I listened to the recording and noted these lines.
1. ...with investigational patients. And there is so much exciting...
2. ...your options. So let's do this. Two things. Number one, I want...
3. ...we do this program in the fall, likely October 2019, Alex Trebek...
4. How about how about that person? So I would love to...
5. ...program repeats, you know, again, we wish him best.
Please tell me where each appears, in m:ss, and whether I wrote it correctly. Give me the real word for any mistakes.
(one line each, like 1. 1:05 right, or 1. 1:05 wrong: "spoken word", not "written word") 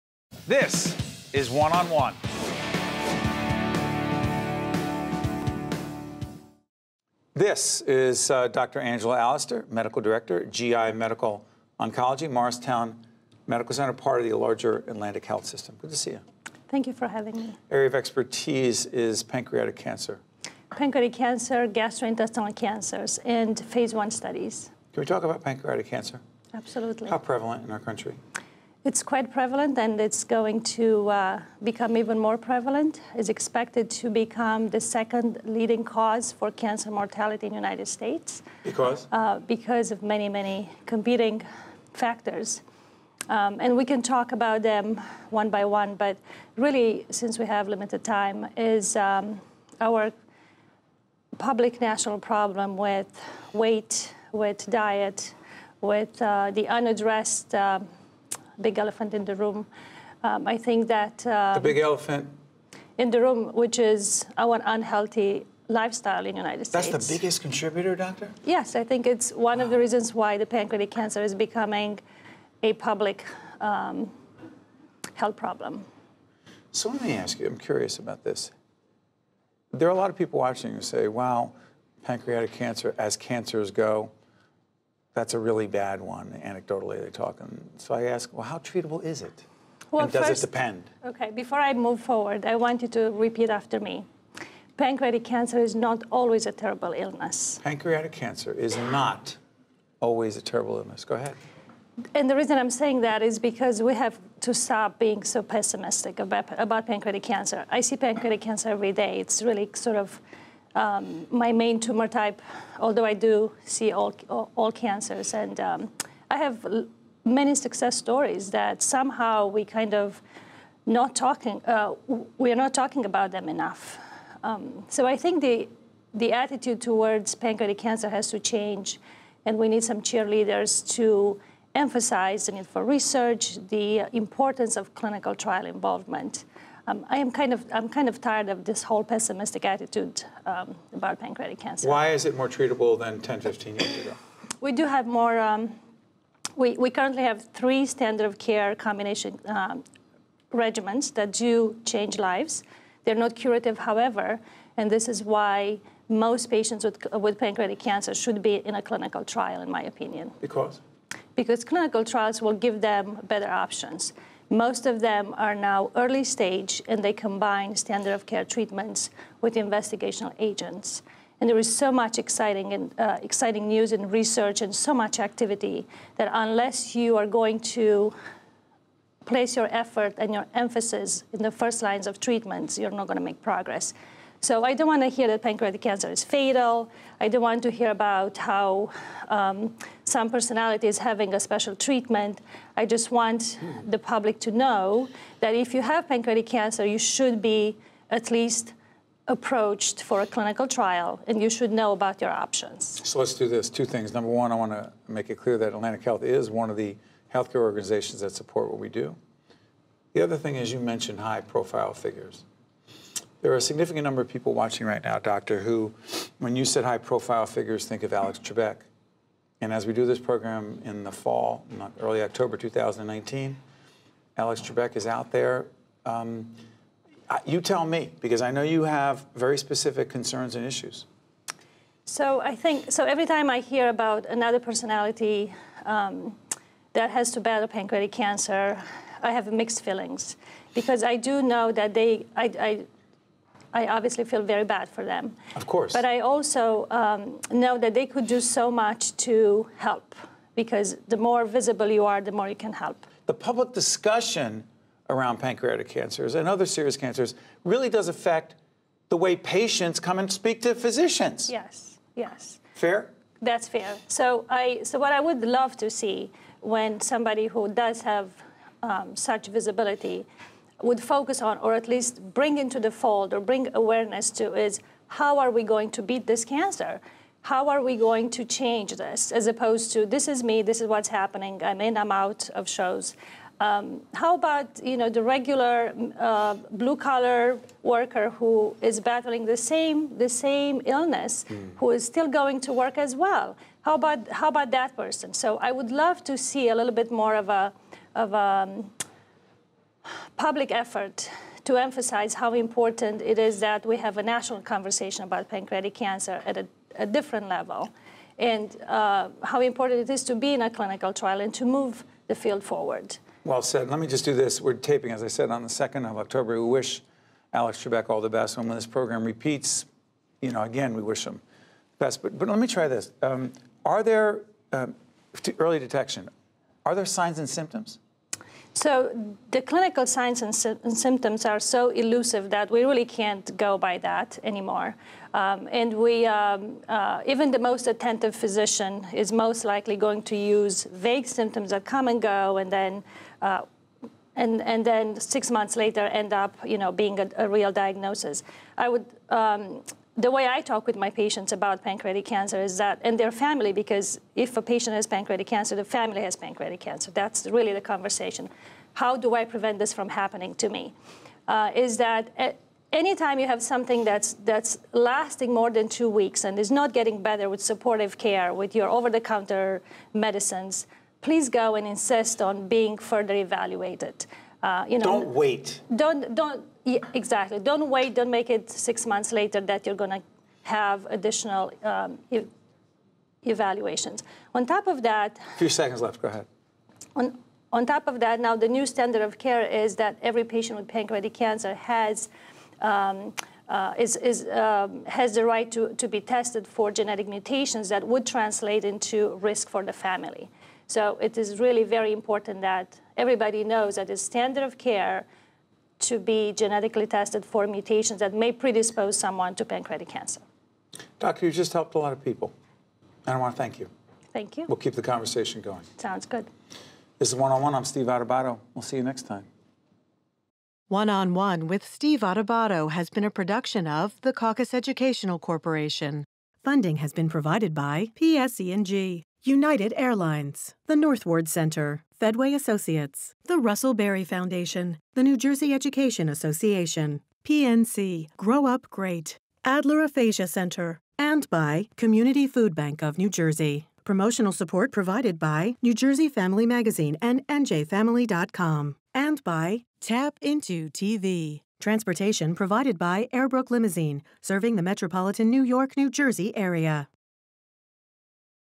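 1. 2:49 wrong: "agents", not "patients"
2. 3:22 right
3. 3:39 wrong: "early", not "likely"
4. 4:53 right
5. 5:18 right.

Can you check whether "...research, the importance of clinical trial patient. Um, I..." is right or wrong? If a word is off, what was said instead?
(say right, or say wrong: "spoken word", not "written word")
wrong: "involvement", not "patient".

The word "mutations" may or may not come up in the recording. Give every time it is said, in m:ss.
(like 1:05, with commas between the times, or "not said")
6:37, 6:47.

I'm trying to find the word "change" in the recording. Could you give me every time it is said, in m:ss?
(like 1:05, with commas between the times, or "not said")
2:08, 2:31, 4:38.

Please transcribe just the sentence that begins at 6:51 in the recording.
Doctor, you just helped a lot of people, and I want to thank you.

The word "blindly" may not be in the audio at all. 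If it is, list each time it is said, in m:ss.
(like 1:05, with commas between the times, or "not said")
not said.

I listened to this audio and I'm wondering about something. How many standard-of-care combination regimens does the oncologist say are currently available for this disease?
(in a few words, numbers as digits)
3.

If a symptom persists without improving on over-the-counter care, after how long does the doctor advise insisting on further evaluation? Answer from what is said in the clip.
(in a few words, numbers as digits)
2 weeks.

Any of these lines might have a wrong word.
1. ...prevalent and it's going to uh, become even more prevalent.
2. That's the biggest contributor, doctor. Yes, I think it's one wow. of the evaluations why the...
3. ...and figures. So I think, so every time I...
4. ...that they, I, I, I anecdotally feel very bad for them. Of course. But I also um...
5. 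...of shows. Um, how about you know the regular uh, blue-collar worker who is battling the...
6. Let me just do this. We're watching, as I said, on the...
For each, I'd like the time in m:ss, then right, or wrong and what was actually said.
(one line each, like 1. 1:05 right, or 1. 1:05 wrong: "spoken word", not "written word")
1. 0:29 right
2. 1:06 wrong: "reasons", not "evaluations"
3. 3:50 wrong: "issues", not "figures"
4. 4:01 wrong: "obviously", not "anecdotally"
5. 4:42 right
6. 5:13 wrong: "taping", not "watching".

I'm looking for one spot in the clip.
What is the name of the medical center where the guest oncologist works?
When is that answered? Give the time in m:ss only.
0:12.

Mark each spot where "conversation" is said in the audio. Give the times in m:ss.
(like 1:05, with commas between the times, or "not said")
5:04, 5:57, 6:55.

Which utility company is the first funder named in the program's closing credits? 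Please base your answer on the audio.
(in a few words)
PSE&G.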